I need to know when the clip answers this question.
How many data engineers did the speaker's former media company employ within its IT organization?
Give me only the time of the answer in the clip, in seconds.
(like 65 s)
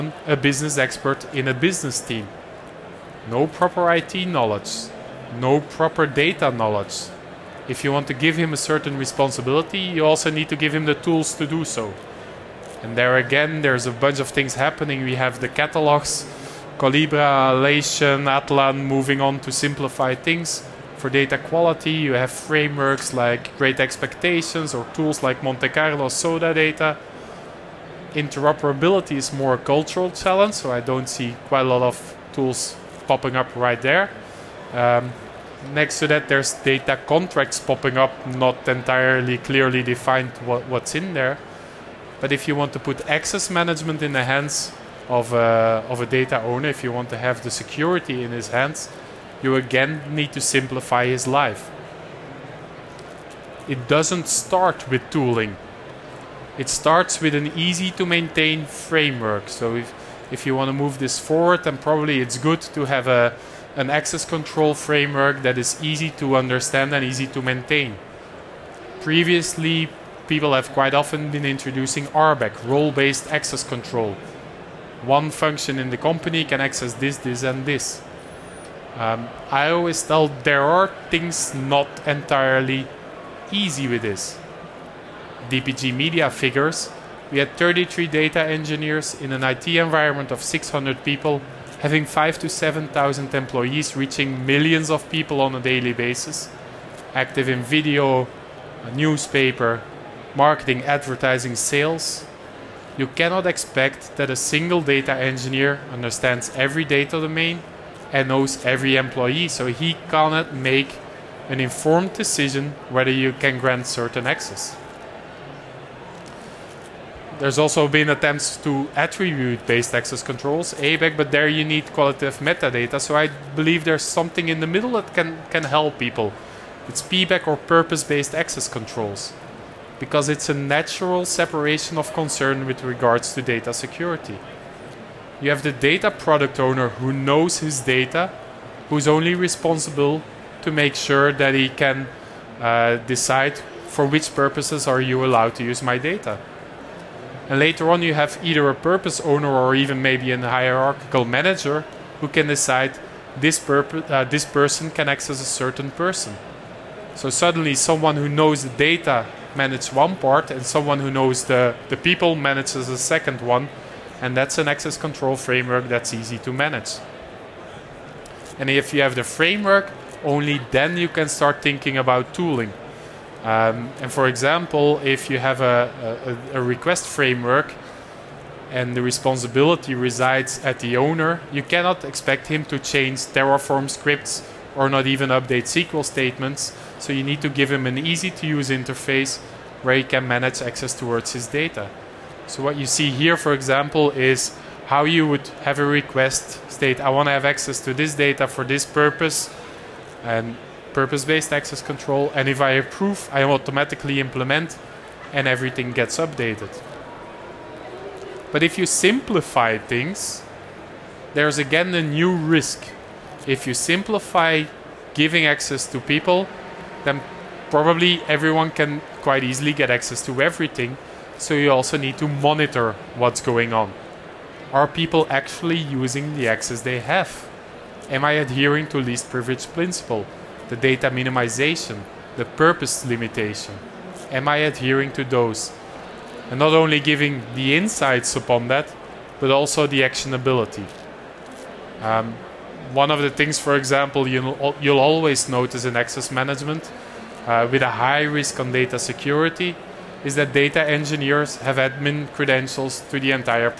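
87 s.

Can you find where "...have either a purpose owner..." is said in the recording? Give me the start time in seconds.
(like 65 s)
148 s.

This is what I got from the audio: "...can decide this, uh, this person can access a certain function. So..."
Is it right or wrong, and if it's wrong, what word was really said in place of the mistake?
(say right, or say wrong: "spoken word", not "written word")
wrong: "person", not "function".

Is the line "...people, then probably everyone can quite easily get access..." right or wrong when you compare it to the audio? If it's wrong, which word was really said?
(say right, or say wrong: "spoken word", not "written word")
right.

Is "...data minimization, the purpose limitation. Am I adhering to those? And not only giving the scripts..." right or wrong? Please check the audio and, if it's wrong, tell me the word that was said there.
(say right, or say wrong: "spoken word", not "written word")
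wrong: "insights", not "scripts".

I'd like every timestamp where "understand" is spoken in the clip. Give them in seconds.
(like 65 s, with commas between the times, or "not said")
66 s, 105 s.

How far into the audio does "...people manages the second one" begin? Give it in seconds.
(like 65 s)
161 s.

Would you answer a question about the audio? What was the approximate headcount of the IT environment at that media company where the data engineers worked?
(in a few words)
600.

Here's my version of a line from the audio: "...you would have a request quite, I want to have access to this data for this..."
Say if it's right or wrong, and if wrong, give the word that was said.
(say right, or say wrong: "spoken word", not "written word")
wrong: "state", not "quite".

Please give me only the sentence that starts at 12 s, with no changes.
And there again, there's a bunch of things happening.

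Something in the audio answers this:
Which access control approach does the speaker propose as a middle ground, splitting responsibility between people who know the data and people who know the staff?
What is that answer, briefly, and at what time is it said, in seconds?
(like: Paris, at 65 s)
PBAC, at 127 s.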